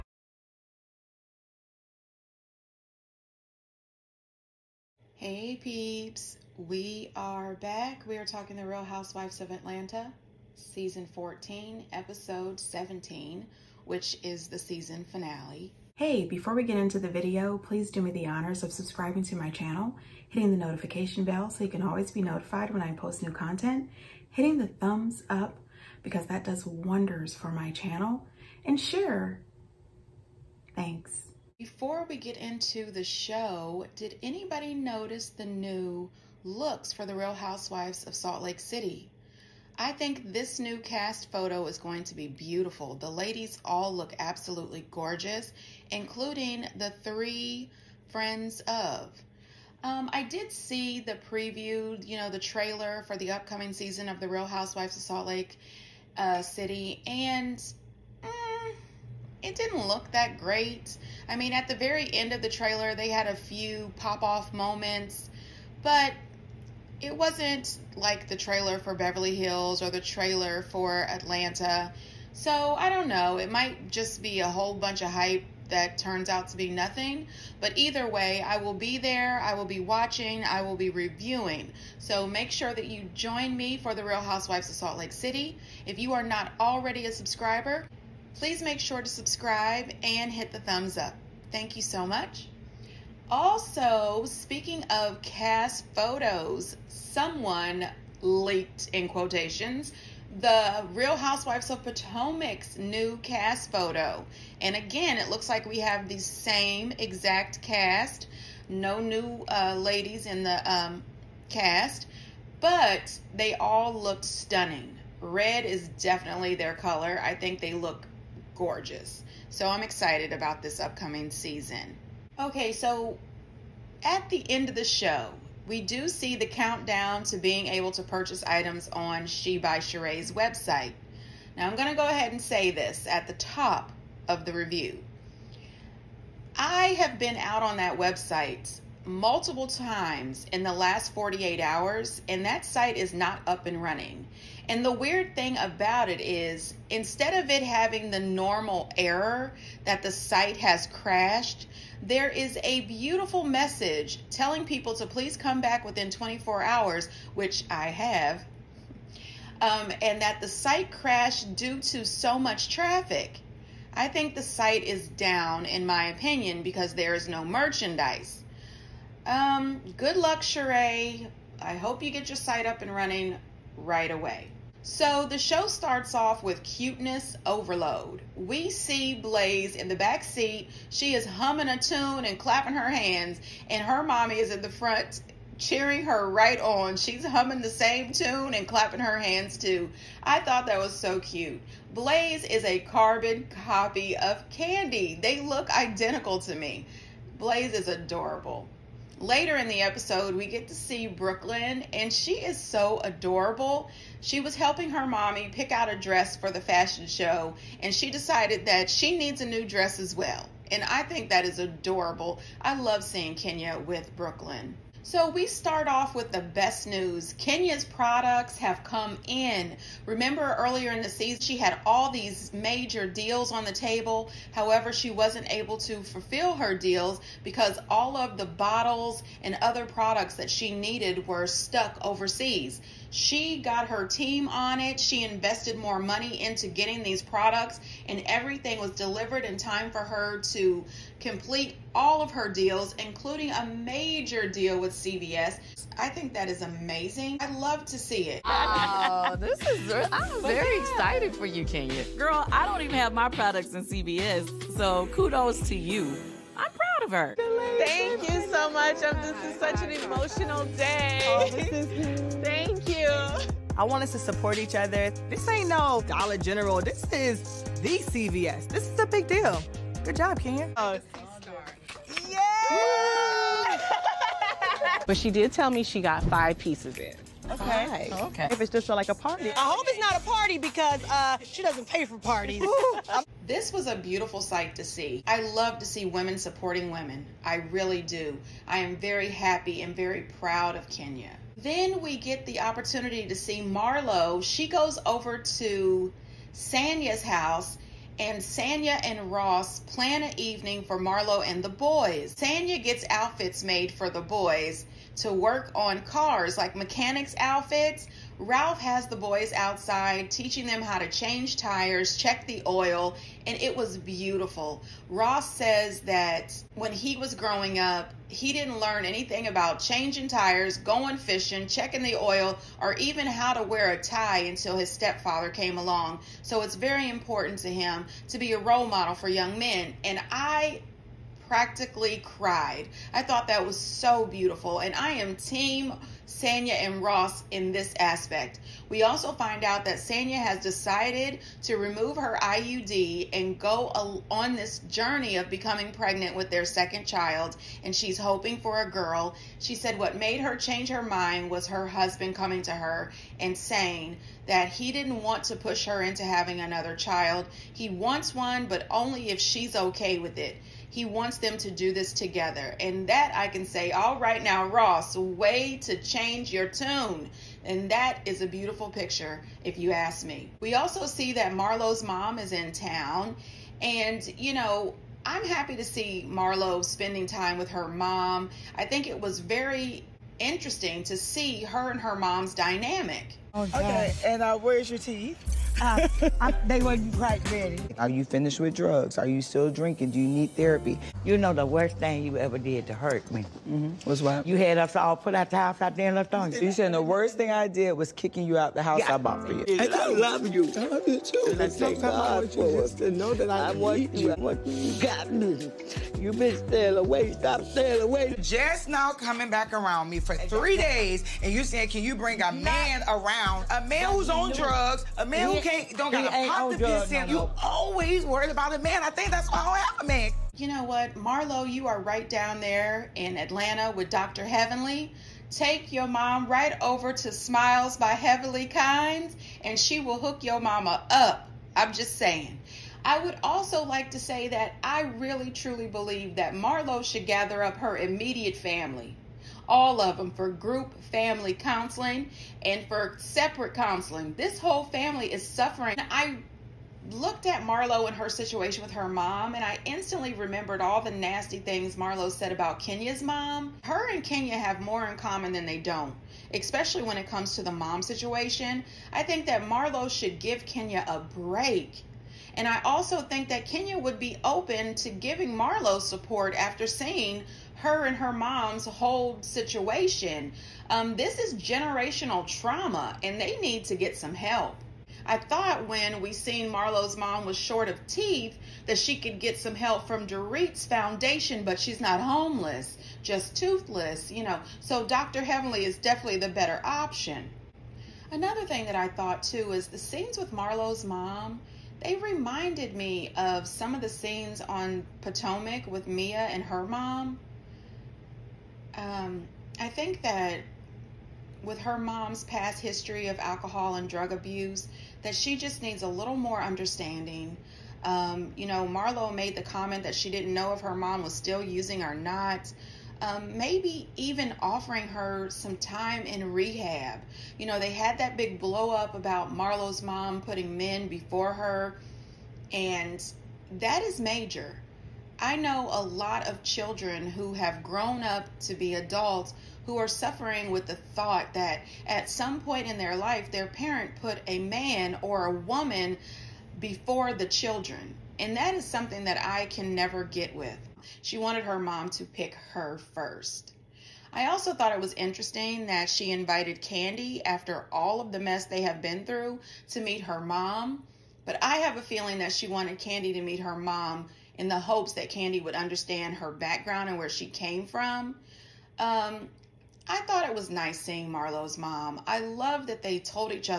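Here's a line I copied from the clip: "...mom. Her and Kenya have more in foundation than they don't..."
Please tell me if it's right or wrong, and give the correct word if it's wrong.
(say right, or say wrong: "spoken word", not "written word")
wrong: "common", not "foundation".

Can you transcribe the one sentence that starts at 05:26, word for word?
So it's very important to him to be a role model for young men.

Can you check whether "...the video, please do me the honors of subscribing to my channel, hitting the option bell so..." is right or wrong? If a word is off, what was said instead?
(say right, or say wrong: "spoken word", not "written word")
wrong: "notification", not "option".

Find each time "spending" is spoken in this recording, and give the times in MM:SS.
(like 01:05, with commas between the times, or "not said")
06:16.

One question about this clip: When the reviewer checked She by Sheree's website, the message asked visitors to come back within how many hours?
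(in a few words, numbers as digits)
24.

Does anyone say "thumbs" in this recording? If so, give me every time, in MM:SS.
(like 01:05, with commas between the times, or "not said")
00:24, 01:30.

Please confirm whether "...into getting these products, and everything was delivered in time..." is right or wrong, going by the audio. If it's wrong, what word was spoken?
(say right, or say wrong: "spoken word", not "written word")
right.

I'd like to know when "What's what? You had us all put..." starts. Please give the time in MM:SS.
06:34.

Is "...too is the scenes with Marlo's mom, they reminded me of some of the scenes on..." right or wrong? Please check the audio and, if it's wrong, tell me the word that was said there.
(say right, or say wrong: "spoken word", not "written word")
right.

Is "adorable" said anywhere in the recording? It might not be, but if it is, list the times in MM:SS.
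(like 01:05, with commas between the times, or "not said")
03:17, 03:23, 03:31.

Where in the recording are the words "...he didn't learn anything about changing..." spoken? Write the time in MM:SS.
05:18.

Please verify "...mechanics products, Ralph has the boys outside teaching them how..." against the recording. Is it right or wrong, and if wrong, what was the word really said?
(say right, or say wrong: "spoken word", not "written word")
wrong: "outfits", not "products".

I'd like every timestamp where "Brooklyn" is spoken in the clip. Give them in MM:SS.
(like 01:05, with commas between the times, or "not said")
03:21, 03:34.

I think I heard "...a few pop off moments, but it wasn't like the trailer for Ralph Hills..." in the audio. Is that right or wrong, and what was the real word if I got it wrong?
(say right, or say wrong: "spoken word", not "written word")
wrong: "Beverly", not "Ralph".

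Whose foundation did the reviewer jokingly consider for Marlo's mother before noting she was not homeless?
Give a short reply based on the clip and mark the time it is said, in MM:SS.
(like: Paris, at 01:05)
Dorit's, at 08:00.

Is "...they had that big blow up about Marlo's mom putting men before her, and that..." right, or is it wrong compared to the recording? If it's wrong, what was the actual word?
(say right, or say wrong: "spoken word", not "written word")
right.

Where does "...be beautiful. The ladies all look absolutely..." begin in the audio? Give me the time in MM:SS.
00:42.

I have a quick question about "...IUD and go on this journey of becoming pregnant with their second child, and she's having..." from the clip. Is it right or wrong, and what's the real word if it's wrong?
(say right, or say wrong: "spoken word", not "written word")
wrong: "hoping", not "having".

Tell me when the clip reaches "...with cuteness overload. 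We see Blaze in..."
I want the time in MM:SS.
02:56.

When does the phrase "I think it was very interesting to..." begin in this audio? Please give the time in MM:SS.
06:18.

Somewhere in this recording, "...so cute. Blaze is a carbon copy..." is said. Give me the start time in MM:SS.
03:10.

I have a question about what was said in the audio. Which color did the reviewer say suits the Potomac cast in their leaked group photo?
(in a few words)
Red.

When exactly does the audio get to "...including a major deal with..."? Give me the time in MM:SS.
04:03.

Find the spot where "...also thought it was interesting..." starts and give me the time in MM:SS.
09:04.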